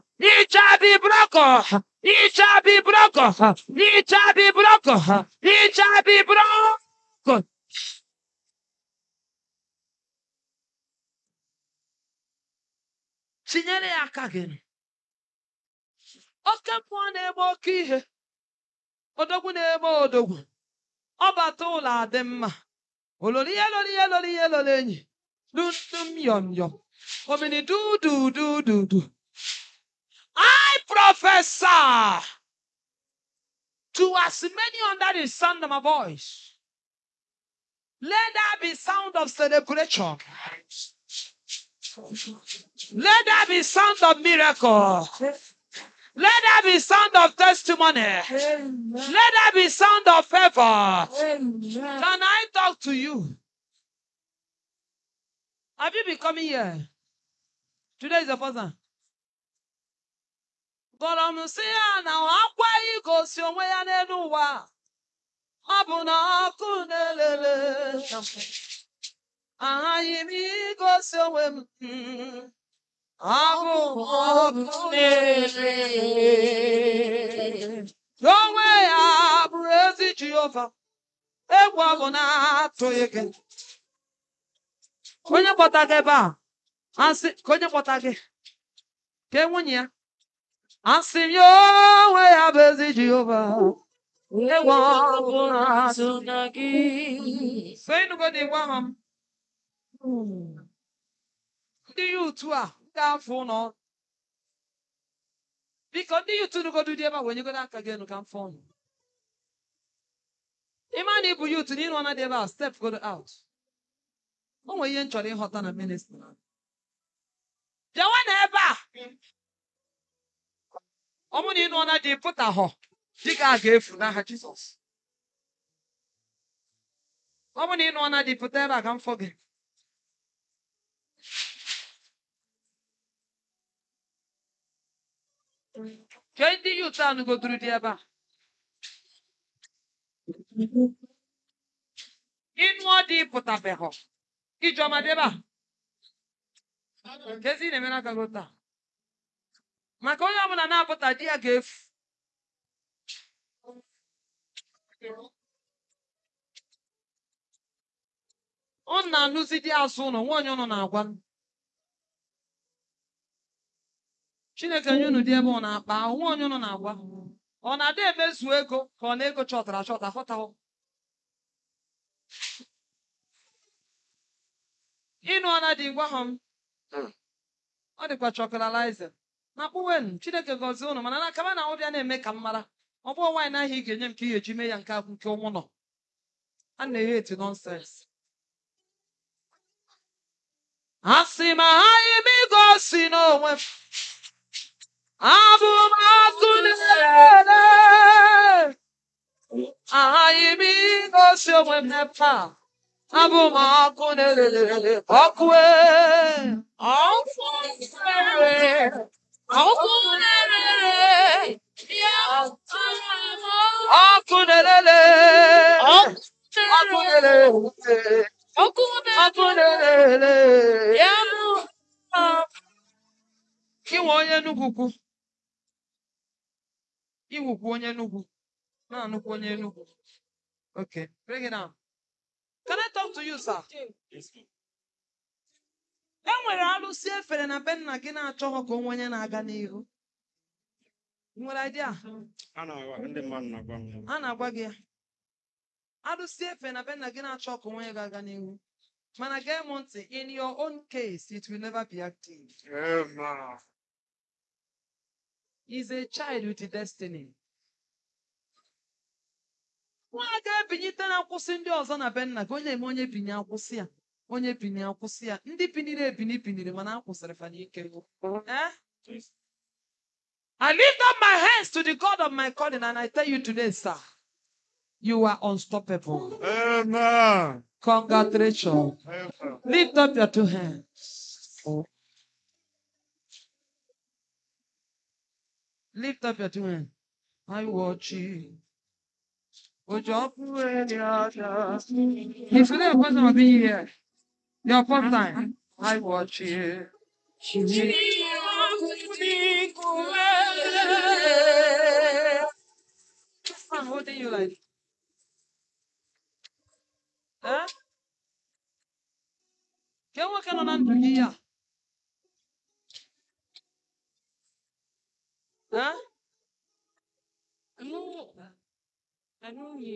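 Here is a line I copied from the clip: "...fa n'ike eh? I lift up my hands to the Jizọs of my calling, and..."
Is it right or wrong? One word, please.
wrong.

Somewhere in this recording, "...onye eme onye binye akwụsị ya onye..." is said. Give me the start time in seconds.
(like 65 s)
262 s.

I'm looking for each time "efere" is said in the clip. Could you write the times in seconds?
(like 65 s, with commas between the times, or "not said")
237 s, 246 s.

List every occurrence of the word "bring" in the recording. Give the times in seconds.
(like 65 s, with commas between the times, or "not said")
231 s.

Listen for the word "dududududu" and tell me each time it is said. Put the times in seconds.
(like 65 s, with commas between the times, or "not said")
27 s.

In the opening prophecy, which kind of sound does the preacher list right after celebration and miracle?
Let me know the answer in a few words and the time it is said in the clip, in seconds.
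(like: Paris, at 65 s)
testimony, at 47 s.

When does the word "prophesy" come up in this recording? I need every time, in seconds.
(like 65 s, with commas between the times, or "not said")
30 s.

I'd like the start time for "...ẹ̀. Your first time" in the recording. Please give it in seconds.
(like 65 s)
293 s.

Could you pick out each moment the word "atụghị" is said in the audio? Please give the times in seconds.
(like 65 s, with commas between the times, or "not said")
82 s, 95 s.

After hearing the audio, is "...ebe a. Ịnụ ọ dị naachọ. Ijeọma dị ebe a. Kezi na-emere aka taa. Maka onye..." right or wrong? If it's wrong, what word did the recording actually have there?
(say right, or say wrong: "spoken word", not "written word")
wrong: "pụtabeghọ", not "naachọ".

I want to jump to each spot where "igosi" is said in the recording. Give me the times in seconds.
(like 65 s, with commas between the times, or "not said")
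70 s, 192 s.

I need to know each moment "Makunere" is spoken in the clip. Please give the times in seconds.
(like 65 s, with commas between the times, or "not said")
195 s, 203 s.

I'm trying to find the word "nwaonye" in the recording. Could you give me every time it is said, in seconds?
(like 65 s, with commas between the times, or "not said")
160 s.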